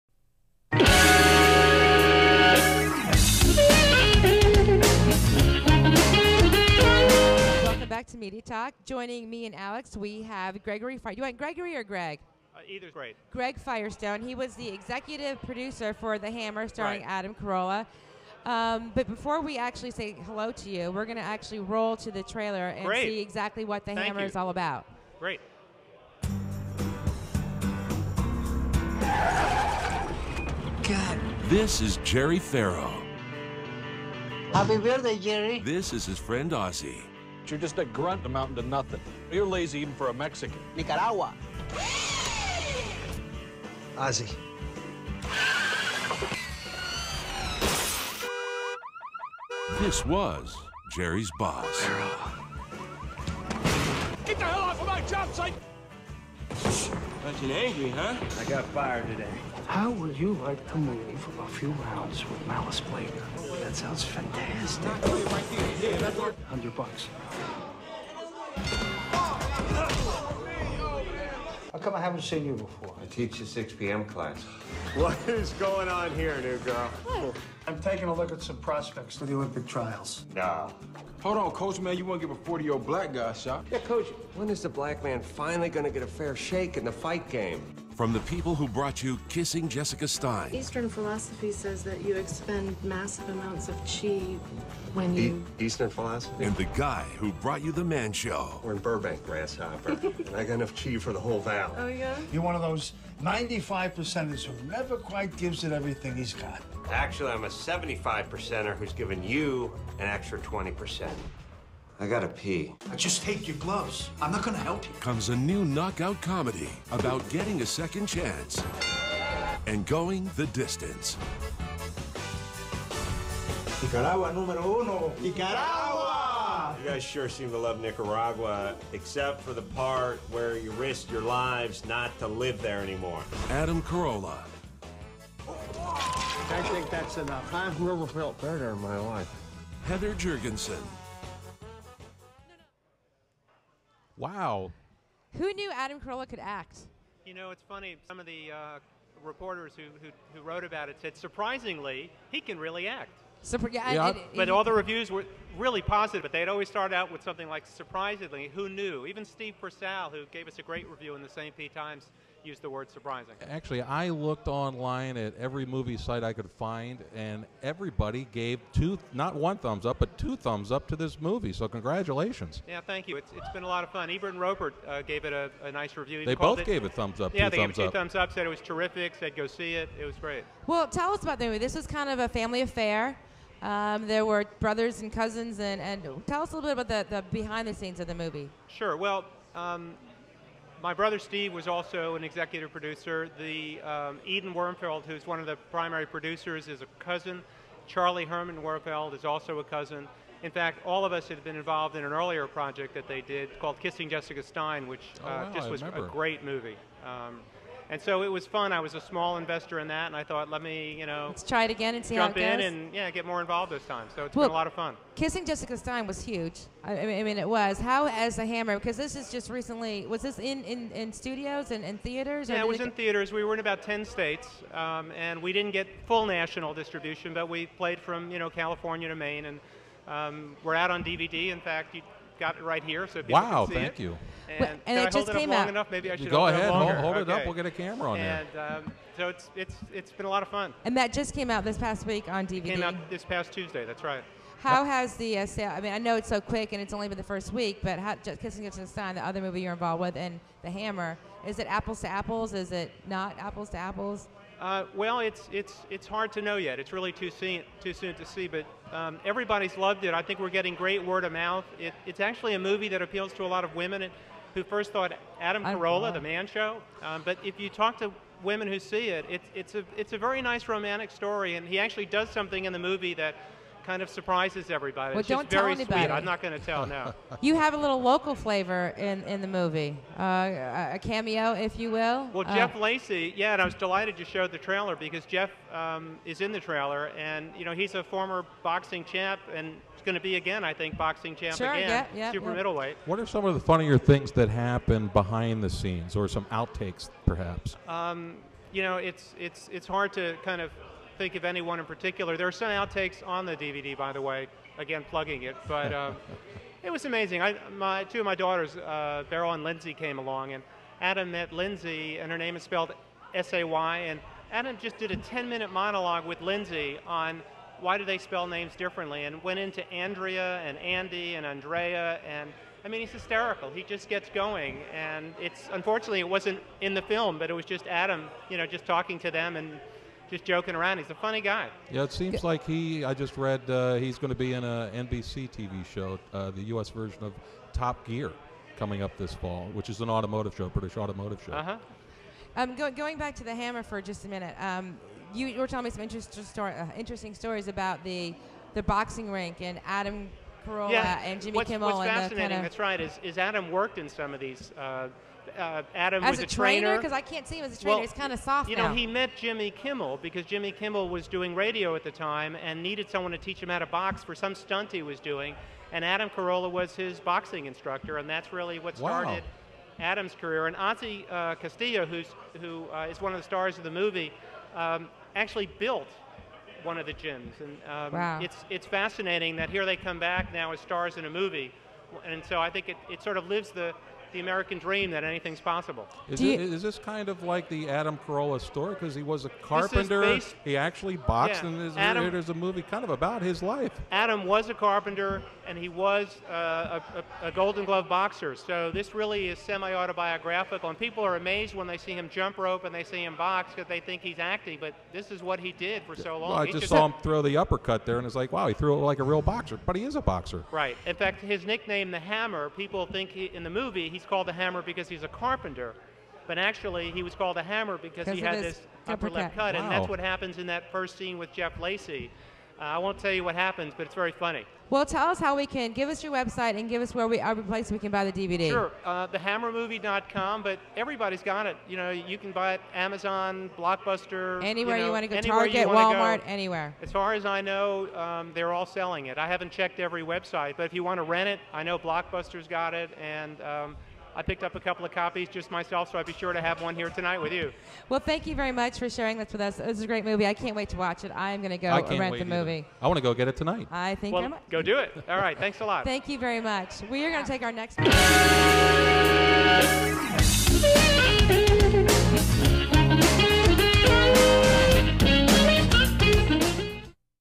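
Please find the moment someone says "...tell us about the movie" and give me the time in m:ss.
3:00.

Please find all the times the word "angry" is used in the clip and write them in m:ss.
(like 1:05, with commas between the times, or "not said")
0:57.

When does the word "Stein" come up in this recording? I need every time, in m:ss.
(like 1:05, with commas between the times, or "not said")
1:30, 3:24, 3:35.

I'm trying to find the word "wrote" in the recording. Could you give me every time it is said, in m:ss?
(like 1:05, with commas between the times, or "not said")
2:30.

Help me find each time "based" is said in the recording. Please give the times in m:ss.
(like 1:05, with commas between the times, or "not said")
6:30.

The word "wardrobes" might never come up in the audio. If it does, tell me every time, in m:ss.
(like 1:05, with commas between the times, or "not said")
not said.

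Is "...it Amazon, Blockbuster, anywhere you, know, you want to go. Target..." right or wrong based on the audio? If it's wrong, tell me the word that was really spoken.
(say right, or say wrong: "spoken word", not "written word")
right.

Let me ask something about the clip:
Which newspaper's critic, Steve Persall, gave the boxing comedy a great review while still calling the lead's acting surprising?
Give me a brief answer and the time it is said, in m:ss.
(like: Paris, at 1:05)
St. Pete Times, at 2:41.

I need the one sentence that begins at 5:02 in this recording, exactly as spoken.
There are some outtakes on the DVD, by the way, again, plugging it.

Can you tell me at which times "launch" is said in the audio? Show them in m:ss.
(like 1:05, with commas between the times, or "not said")
not said.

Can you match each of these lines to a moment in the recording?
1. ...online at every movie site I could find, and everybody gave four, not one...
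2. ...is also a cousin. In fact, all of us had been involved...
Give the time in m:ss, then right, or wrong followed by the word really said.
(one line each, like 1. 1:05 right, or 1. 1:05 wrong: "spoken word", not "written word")
1. 2:44 wrong: "two", not "four"
2. 3:19 right.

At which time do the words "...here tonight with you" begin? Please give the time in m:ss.
7:26.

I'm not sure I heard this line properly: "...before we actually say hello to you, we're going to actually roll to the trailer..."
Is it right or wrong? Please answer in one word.
right.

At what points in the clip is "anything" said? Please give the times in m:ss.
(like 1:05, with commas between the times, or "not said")
6:25.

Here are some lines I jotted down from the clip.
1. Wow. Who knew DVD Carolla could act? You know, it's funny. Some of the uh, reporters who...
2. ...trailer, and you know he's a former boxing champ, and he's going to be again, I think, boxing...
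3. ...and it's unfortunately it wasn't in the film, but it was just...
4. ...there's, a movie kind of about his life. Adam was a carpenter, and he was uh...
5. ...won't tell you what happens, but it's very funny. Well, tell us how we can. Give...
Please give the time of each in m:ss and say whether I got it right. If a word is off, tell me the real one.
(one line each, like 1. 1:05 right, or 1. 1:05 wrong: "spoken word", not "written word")
1. 2:24 wrong: "Adam", not "DVD"
2. 4:46 right
3. 5:24 right
4. 6:32 right
5. 7:02 right.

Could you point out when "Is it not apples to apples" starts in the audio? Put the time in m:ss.
4:12.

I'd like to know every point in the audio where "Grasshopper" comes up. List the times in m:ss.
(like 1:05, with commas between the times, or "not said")
1:39.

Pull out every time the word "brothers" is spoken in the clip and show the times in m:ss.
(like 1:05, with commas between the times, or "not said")
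3:04, 3:10.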